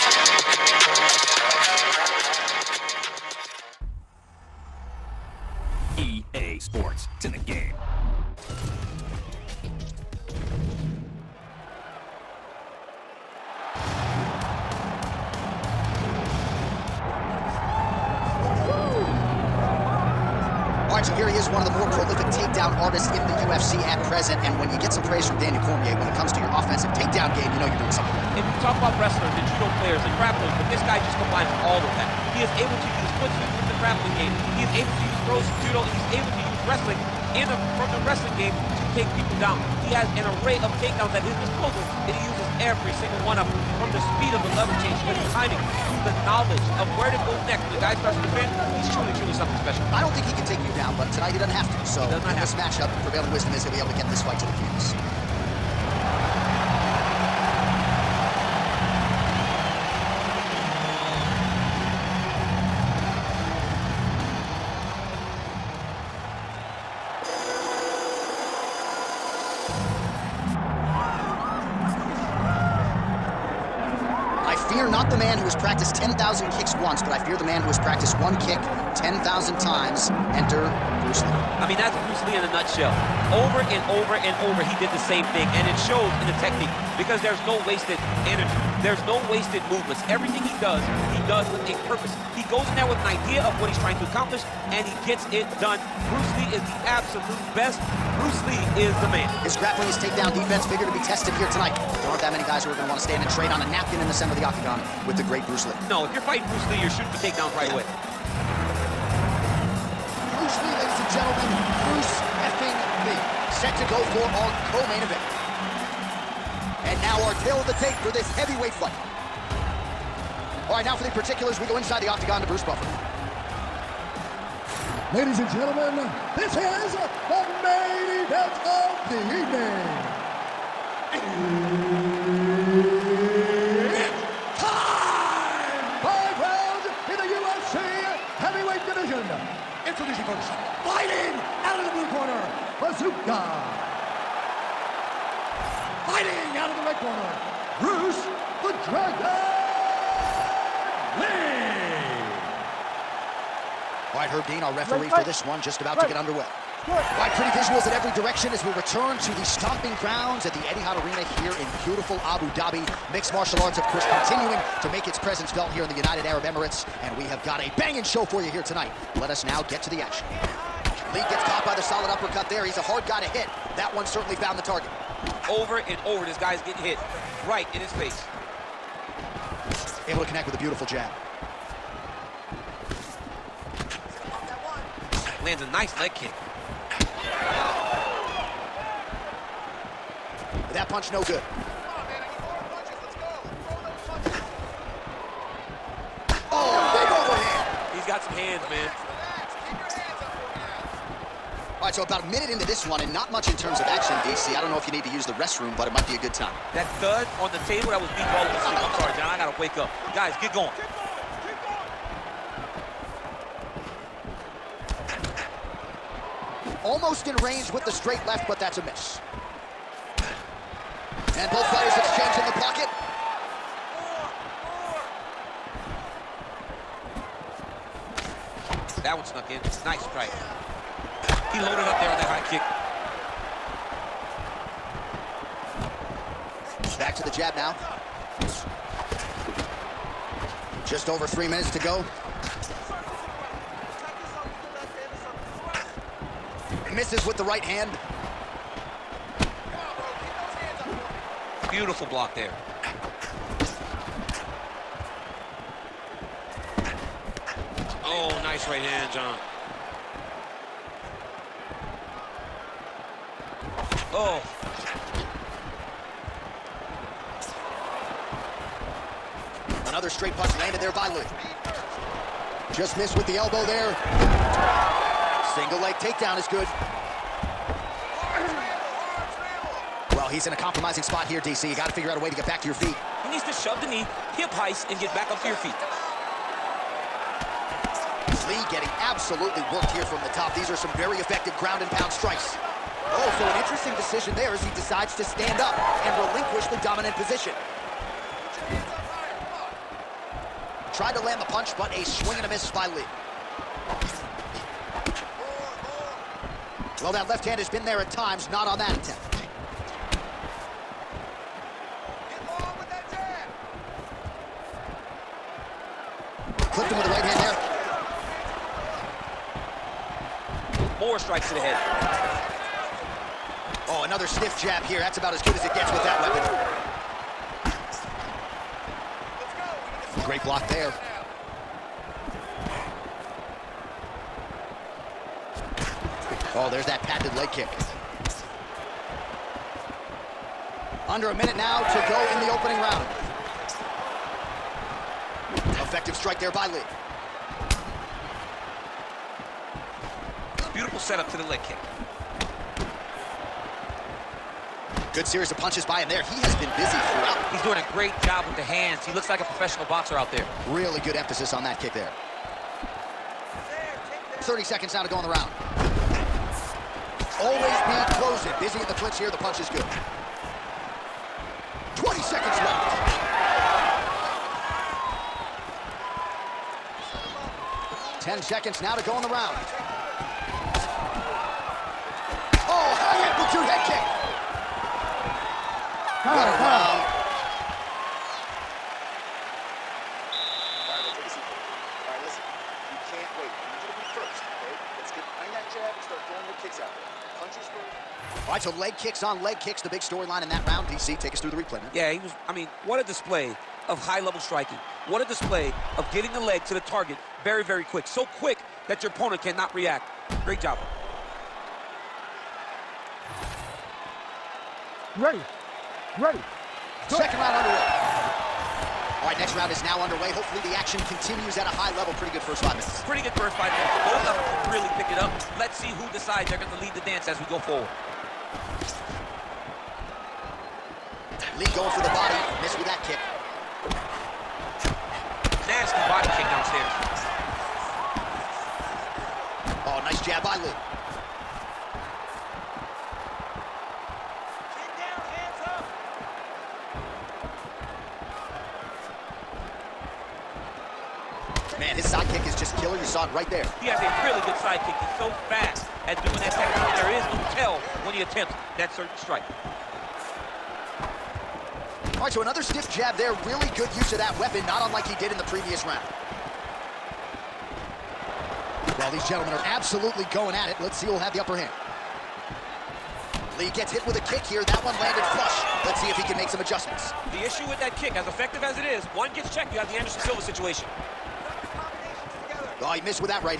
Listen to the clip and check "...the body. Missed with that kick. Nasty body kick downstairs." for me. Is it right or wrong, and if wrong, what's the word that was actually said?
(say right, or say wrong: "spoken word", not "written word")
right.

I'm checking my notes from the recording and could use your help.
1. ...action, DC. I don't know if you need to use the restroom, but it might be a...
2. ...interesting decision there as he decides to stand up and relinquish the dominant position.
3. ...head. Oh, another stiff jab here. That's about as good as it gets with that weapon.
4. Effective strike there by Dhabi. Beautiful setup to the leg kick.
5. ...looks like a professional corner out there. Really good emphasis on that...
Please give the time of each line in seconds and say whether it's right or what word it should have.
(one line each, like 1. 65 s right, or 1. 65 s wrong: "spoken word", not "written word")
1. 203 s right
2. 293 s right
3. 321 s right
4. 345 s wrong: "Lee", not "Dhabi"
5. 359 s wrong: "boxer", not "corner".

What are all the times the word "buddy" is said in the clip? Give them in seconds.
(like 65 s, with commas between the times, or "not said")
not said.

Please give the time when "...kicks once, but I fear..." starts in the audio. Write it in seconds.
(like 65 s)
76 s.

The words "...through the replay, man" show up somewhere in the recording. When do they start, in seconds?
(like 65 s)
401 s.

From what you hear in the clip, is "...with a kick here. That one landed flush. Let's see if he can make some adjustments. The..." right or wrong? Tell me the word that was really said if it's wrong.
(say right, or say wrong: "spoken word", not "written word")
right.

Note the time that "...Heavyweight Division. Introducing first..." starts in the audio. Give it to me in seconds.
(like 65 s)
138 s.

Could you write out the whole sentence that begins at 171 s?
Lee gets caught by the solid uppercut there.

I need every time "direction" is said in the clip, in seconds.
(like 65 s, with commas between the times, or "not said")
158 s.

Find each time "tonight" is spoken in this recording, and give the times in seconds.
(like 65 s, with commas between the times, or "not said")
51 s, 101 s, 168 s.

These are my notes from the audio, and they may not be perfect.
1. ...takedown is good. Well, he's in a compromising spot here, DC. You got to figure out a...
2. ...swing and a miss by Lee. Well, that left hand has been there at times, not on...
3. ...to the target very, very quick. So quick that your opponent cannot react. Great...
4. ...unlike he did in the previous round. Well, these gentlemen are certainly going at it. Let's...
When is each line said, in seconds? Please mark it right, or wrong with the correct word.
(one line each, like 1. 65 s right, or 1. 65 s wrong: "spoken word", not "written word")
1. 276 s right
2. 302 s right
3. 406 s right
4. 464 s wrong: "absolutely", not "certainly".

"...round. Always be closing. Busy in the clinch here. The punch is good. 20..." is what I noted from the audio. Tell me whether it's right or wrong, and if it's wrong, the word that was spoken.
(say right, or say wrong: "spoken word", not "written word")
right.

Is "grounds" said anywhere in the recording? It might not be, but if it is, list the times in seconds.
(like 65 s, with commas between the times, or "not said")
159 s, 291 s.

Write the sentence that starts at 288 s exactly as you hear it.
Lee getting absolutely worked here from the top.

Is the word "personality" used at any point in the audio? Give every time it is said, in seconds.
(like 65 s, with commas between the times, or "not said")
not said.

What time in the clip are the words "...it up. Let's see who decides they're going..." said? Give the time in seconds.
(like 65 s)
425 s.